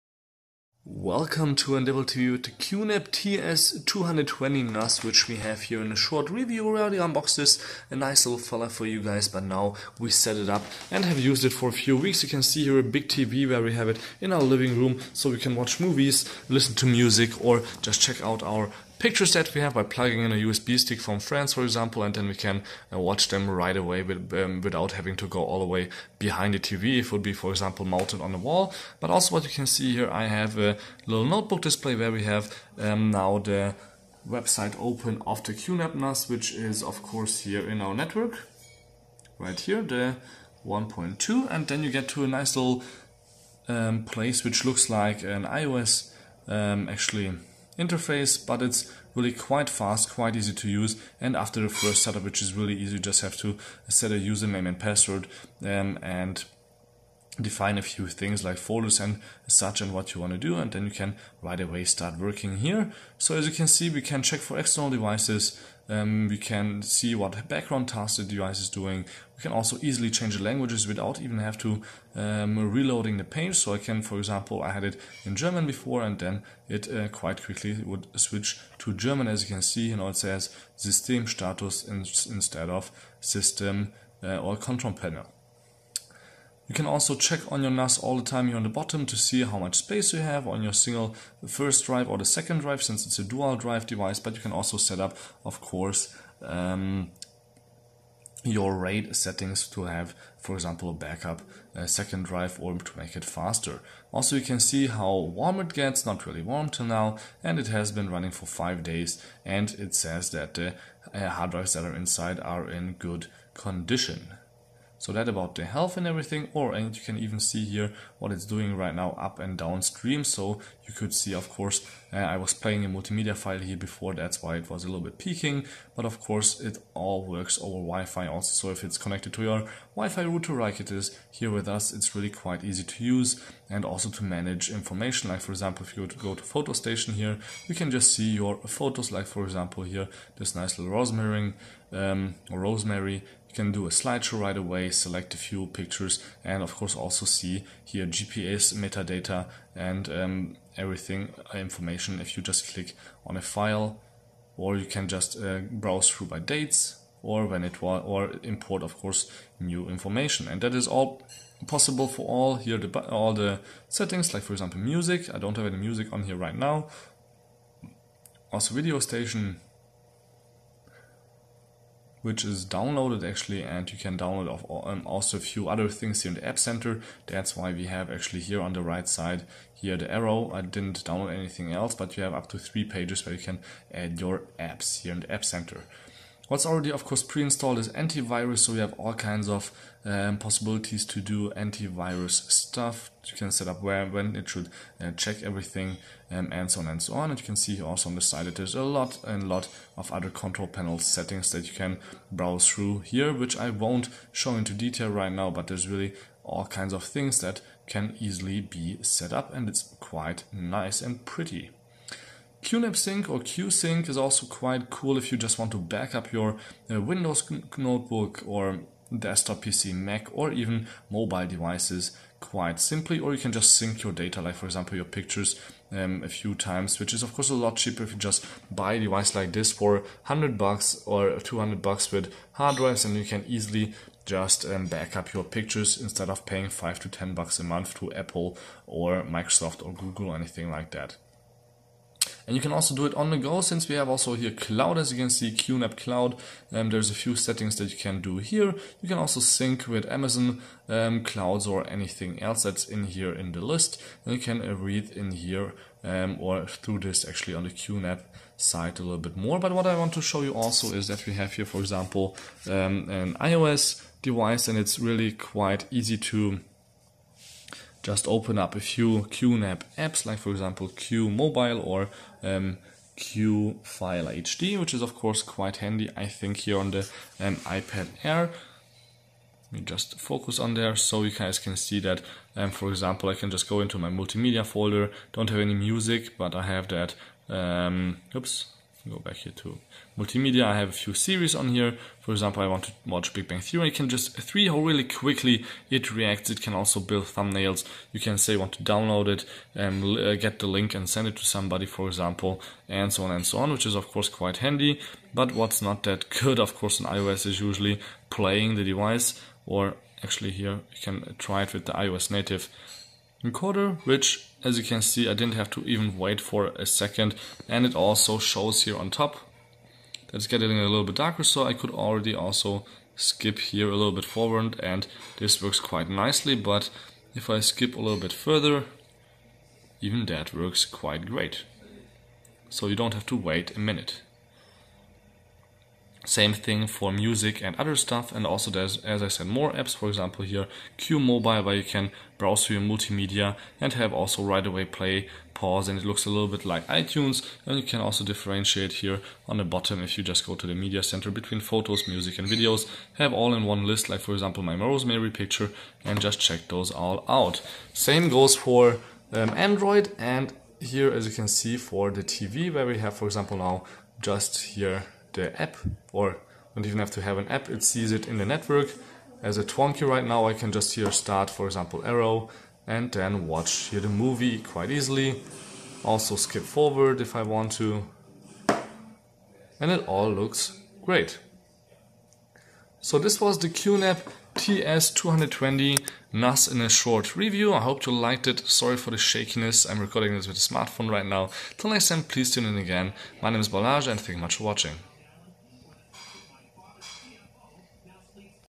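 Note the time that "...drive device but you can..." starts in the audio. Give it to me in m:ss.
1:33.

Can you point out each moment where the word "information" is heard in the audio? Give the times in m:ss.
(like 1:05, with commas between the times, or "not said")
2:14, 2:31, 2:39.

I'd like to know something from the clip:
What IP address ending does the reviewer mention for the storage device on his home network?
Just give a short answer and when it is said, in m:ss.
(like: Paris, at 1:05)
1.2, at 0:39.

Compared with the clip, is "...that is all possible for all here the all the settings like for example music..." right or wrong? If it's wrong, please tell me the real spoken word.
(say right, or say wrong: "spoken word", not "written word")
right.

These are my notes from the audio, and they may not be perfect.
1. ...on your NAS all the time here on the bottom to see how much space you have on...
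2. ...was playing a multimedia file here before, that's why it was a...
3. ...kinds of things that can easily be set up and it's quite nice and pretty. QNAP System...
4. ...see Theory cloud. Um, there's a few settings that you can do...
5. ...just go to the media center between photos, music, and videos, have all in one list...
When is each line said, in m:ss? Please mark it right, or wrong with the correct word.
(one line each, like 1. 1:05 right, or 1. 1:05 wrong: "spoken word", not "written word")
1. 1:27 right
2. 2:02 right
3. 3:26 wrong: "Sync", not "System"
4. 4:05 wrong: "QNAP", not "Theory"
5. 5:50 right.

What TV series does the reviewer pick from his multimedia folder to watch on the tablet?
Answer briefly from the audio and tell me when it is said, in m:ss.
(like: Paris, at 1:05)
Big Bang Theory, at 4:53.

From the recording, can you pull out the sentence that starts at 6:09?
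As a Twonky right now, I can just here start, for example, arrow and then watch here the movie quite easily.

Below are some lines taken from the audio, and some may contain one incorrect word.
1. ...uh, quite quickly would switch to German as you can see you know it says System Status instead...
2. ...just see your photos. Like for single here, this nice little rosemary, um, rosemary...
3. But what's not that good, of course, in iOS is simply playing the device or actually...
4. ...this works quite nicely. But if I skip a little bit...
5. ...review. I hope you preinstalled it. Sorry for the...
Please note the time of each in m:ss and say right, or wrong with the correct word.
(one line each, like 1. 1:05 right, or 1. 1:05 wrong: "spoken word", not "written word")
1. 1:16 right
2. 2:17 wrong: "example", not "single"
3. 5:05 wrong: "usually", not "simply"
4. 5:25 right
5. 6:27 wrong: "liked", not "preinstalled".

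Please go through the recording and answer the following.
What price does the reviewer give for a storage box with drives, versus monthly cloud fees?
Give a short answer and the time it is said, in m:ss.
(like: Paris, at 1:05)
100 or 200 bucks, at 3:50.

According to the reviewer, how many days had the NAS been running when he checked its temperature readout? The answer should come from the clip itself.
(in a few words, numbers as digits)
5.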